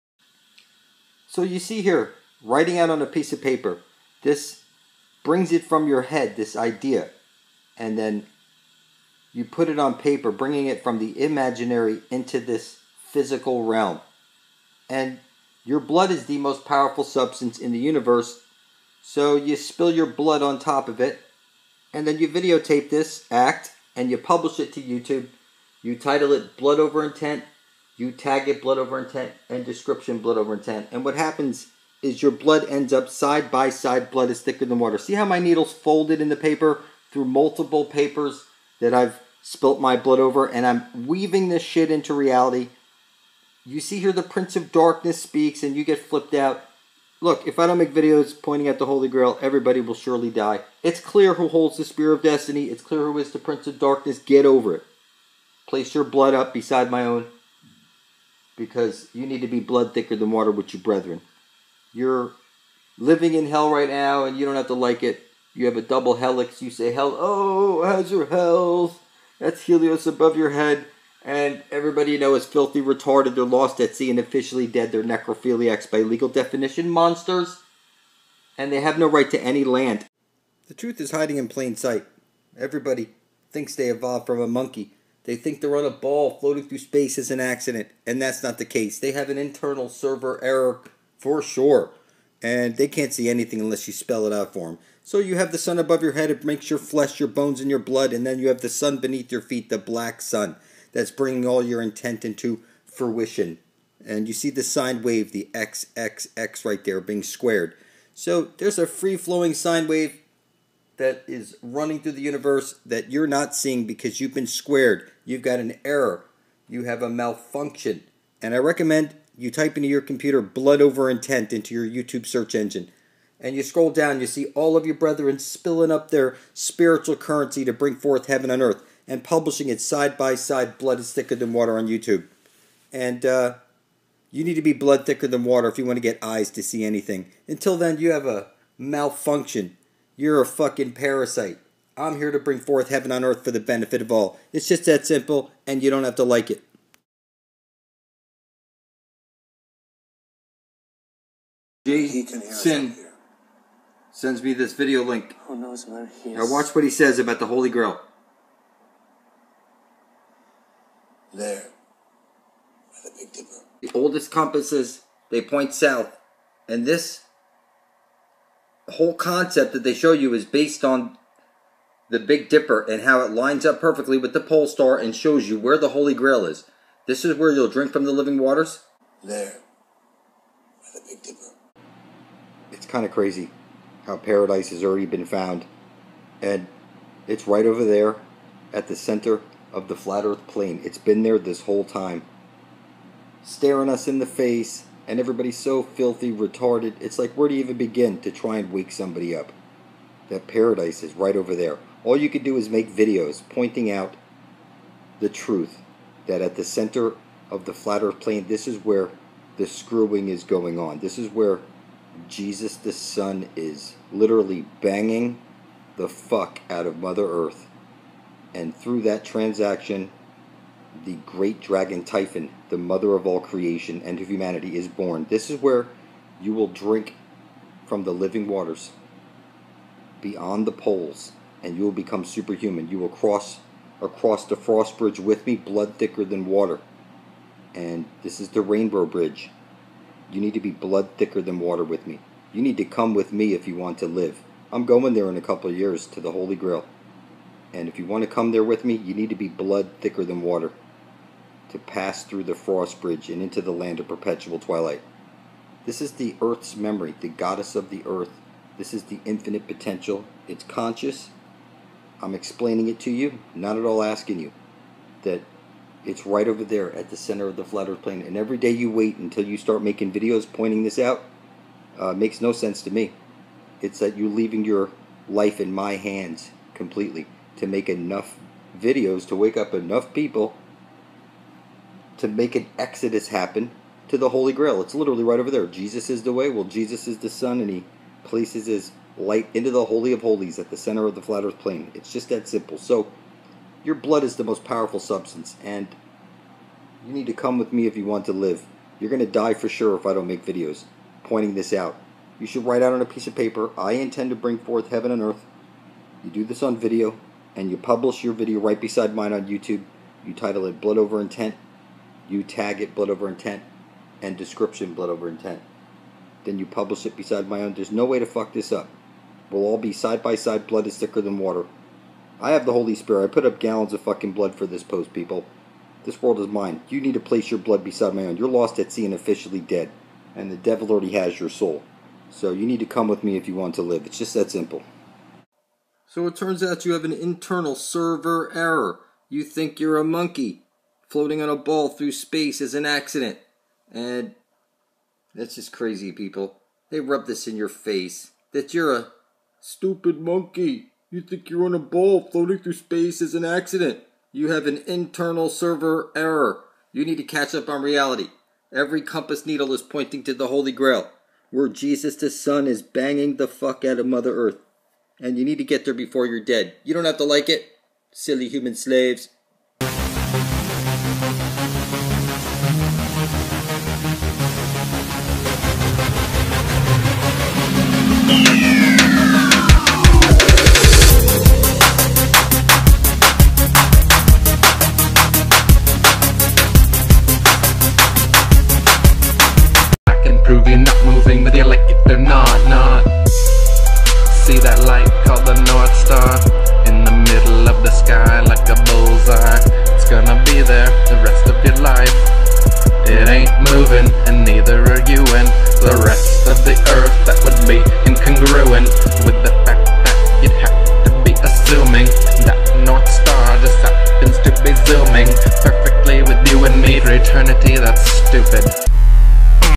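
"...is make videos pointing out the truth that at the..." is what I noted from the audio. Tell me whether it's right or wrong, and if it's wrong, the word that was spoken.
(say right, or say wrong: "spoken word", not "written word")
right.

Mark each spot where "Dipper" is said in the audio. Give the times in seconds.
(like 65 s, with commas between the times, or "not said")
163 s, 172 s, 181 s.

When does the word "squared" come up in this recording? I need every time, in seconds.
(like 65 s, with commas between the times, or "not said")
107 s, 114 s.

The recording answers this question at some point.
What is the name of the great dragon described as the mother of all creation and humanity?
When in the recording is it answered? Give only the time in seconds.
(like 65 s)
222 s.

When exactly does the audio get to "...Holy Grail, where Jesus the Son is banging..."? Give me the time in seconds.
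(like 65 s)
360 s.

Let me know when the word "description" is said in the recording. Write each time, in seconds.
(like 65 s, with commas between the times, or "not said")
29 s, 314 s.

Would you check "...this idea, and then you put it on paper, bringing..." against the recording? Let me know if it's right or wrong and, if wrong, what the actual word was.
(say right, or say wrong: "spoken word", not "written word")
right.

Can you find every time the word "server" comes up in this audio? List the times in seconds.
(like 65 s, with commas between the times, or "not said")
89 s, 337 s, 355 s.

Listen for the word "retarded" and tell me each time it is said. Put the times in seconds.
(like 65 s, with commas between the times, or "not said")
72 s, 196 s.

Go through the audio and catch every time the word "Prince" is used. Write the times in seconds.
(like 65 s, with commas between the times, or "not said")
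44 s, 53 s.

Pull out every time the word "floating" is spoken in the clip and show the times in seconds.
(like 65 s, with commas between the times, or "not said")
86 s, 341 s, 352 s.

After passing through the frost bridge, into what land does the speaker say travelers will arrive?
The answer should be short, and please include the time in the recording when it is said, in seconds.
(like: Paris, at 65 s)
land of perpetual twilight, at 253 s.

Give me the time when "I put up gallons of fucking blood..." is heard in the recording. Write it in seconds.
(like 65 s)
323 s.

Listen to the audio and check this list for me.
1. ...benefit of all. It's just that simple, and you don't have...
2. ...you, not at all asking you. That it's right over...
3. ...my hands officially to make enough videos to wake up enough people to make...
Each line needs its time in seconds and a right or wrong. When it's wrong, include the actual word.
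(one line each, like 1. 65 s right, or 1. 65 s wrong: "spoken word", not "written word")
1. 143 s right
2. 263 s right
3. 275 s wrong: "completely", not "officially".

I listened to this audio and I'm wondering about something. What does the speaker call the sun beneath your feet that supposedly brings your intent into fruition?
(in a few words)
the black sun.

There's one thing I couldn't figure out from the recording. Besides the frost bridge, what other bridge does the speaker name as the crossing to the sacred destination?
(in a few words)
rainbow bridge.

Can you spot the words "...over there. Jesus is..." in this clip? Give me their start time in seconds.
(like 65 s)
285 s.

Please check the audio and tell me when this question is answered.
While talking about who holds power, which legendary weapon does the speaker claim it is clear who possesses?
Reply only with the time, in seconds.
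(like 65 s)
51 s.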